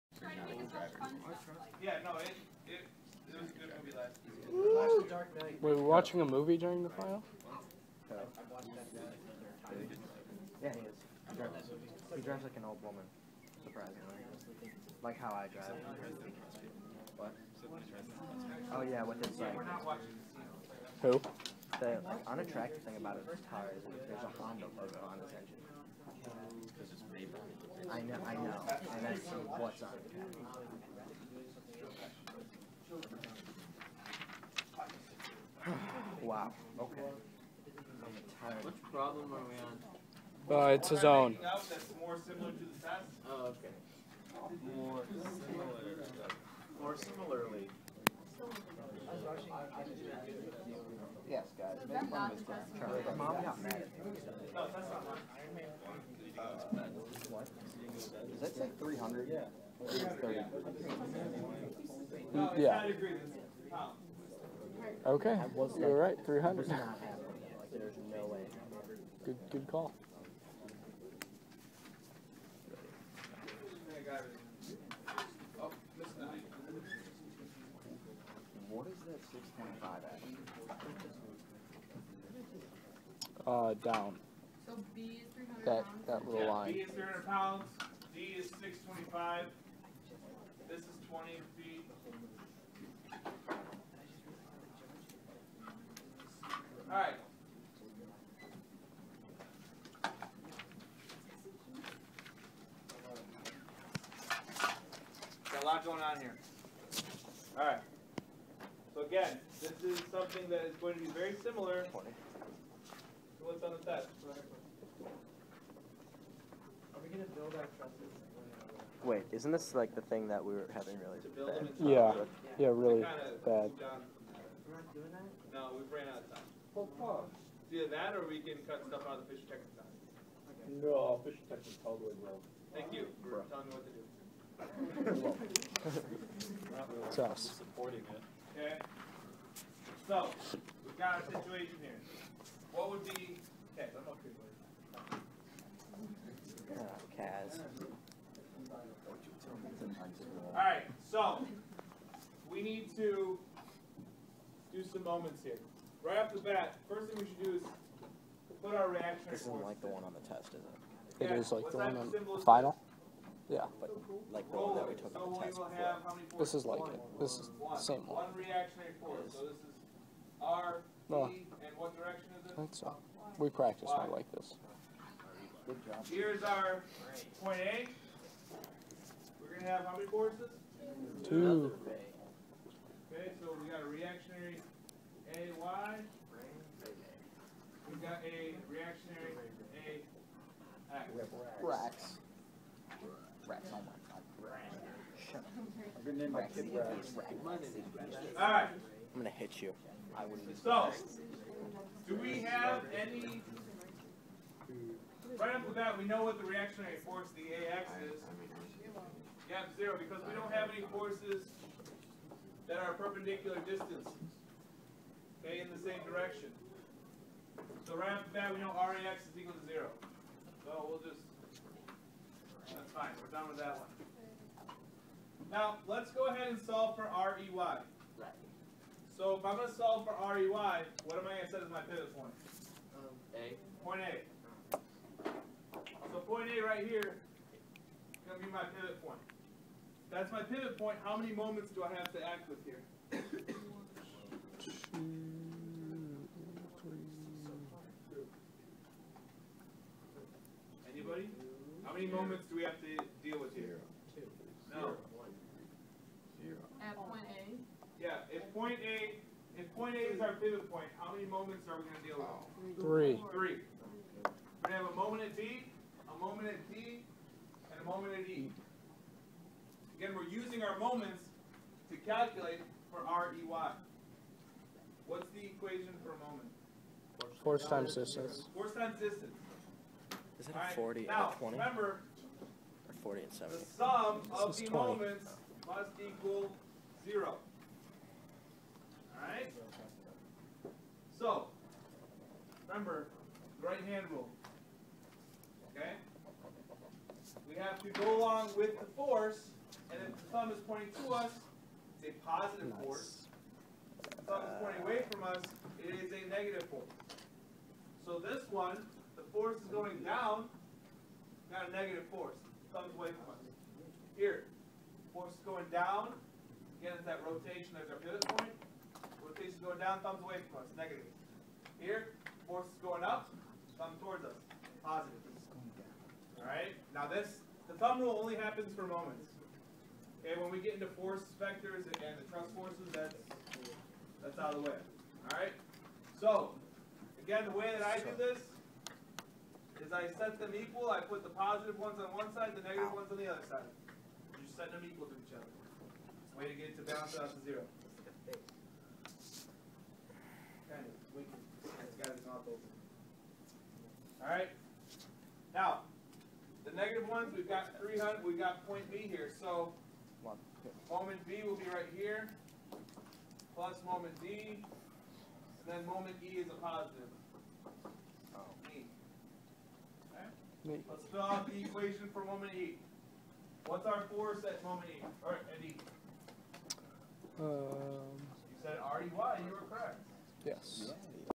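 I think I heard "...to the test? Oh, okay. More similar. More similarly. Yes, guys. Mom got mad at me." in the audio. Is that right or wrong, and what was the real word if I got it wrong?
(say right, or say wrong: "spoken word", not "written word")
right.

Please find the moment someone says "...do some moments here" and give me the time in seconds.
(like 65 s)
154 s.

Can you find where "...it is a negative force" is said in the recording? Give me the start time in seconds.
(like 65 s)
305 s.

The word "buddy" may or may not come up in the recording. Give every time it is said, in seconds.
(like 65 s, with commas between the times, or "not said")
144 s.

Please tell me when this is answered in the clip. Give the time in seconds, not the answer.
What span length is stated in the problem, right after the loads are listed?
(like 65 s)
91 s.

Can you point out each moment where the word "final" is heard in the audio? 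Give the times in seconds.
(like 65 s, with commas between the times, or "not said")
6 s, 162 s.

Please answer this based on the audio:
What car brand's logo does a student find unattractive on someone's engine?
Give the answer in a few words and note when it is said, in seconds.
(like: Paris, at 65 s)
Honda, at 24 s.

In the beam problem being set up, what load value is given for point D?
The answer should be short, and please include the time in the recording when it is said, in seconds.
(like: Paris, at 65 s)
625, at 88 s.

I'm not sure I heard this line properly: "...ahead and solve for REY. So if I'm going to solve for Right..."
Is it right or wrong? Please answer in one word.
wrong.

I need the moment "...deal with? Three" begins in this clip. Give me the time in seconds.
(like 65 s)
262 s.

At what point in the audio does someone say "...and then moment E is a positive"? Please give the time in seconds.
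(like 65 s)
364 s.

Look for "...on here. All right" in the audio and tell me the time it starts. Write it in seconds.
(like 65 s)
106 s.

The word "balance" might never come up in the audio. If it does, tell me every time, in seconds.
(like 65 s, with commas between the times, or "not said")
346 s.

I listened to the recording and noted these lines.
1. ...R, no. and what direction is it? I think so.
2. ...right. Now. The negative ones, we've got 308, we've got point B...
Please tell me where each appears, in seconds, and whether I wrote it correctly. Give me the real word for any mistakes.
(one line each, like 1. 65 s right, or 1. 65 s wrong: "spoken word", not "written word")
1. 170 s right
2. 354 s wrong: "300", not "308".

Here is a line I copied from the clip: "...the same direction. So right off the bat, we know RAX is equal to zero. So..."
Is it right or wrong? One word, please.
right.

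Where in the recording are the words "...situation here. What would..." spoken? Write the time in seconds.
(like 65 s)
141 s.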